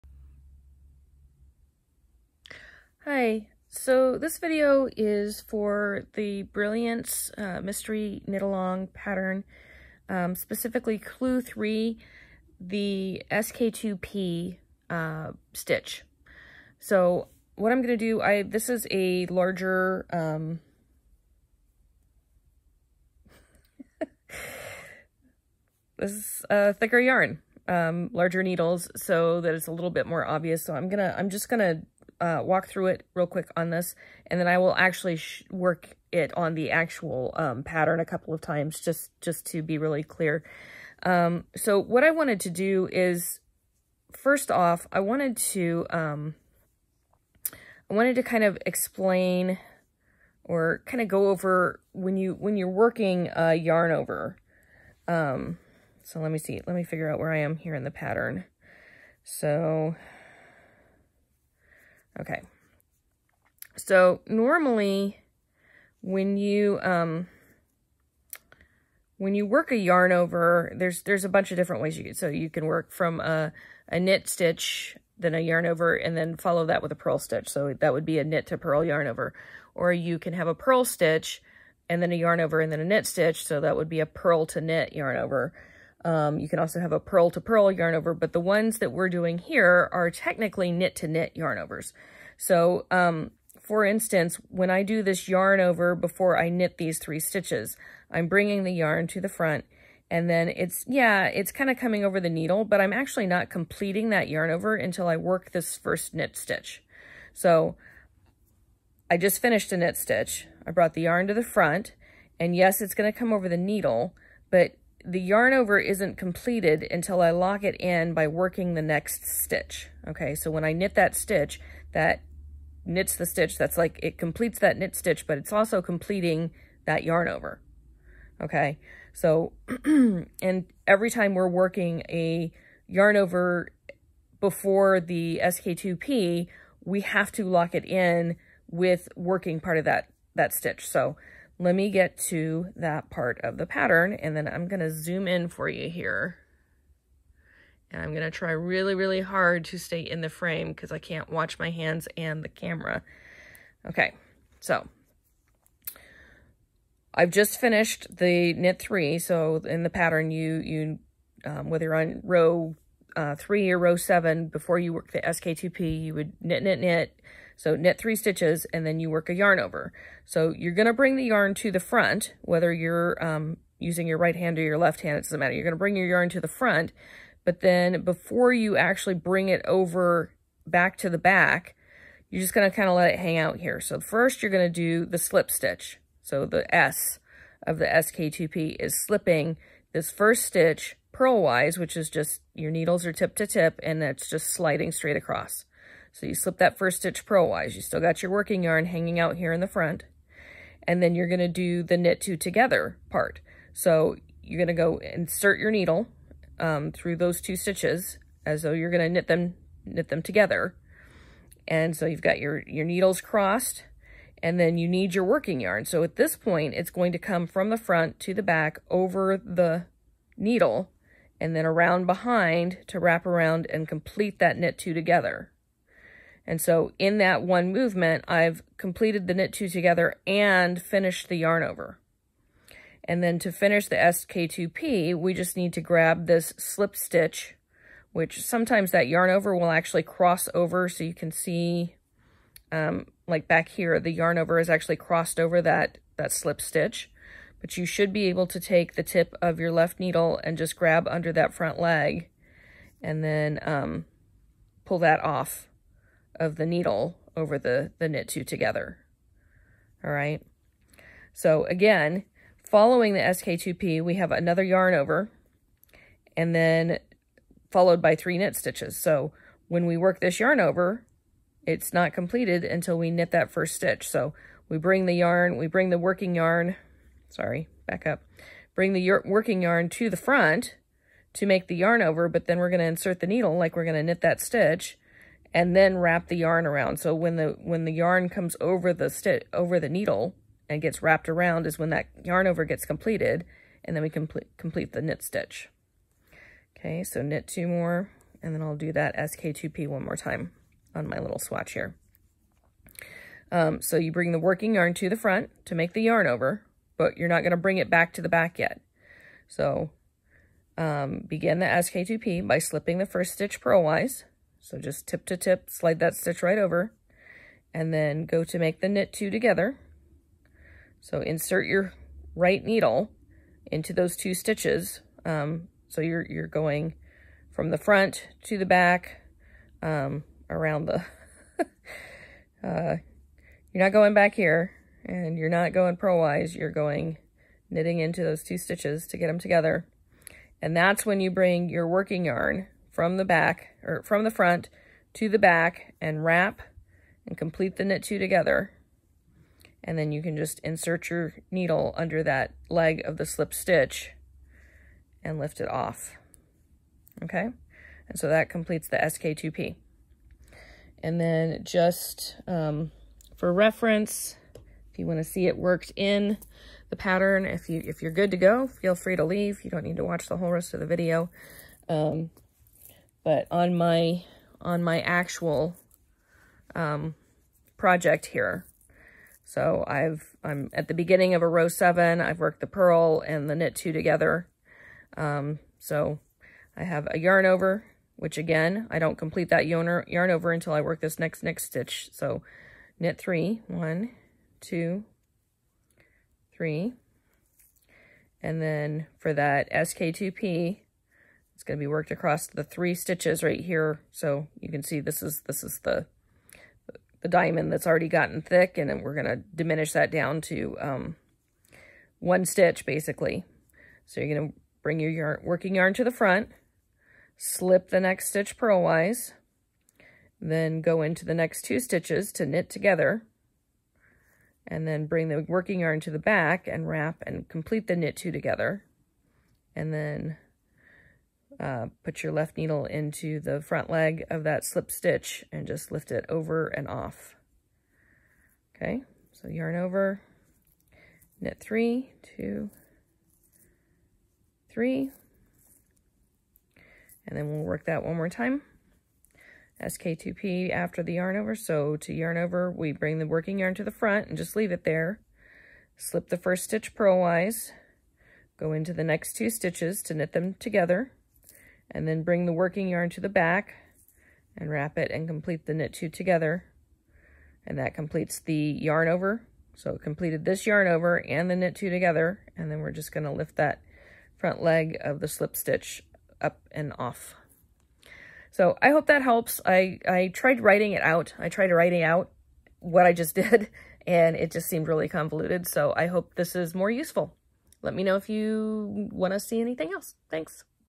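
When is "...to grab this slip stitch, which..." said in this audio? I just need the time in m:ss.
3:55.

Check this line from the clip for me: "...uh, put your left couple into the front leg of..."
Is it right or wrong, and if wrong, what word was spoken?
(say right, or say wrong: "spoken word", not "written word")
wrong: "needle", not "couple".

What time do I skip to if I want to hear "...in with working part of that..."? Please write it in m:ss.
2:17.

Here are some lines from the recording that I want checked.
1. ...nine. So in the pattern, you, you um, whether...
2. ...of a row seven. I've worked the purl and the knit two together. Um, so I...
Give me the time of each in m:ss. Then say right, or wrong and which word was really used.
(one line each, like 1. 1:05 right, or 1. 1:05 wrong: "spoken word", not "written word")
1. 2:38 wrong: "three", not "nine"
2. 6:21 right.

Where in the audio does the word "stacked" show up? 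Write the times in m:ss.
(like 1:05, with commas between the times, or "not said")
not said.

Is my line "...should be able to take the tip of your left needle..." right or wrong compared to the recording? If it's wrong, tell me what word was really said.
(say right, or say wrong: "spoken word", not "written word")
right.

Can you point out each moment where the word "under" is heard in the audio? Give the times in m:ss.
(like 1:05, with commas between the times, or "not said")
4:11, 5:51.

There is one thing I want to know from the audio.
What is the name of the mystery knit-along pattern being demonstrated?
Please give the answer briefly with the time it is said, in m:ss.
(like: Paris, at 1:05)
Brilliance, at 0:06.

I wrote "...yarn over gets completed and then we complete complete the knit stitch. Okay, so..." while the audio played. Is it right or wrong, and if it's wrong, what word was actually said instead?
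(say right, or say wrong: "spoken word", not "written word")
right.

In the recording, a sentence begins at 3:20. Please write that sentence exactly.
And then you're going to do the knit two together part.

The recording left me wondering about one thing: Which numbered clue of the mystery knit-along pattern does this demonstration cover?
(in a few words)
Clue 3.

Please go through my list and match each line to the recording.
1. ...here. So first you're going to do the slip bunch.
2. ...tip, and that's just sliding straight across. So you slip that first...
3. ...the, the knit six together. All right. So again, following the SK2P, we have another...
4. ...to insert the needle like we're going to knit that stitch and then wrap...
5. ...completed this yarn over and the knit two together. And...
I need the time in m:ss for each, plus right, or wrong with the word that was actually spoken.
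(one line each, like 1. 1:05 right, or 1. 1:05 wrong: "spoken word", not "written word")
1. 3:03 wrong: "stitch", not "bunch"
2. 3:13 right
3. 4:17 wrong: "two", not "six"
4. 4:42 right
5. 7:50 right.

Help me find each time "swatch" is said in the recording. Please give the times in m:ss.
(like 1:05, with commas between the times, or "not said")
5:01.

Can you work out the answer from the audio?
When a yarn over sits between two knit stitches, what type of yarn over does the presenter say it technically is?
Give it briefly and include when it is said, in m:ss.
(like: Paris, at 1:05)
knit to knit, at 1:30.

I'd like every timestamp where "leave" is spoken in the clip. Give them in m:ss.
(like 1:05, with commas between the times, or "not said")
6:09, 7:34.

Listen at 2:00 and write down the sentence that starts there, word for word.
Okay, so when I knit that stitch, that knits the stitch.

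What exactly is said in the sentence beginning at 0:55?
Um, so let me see, let me figure out where I am here in the pattern.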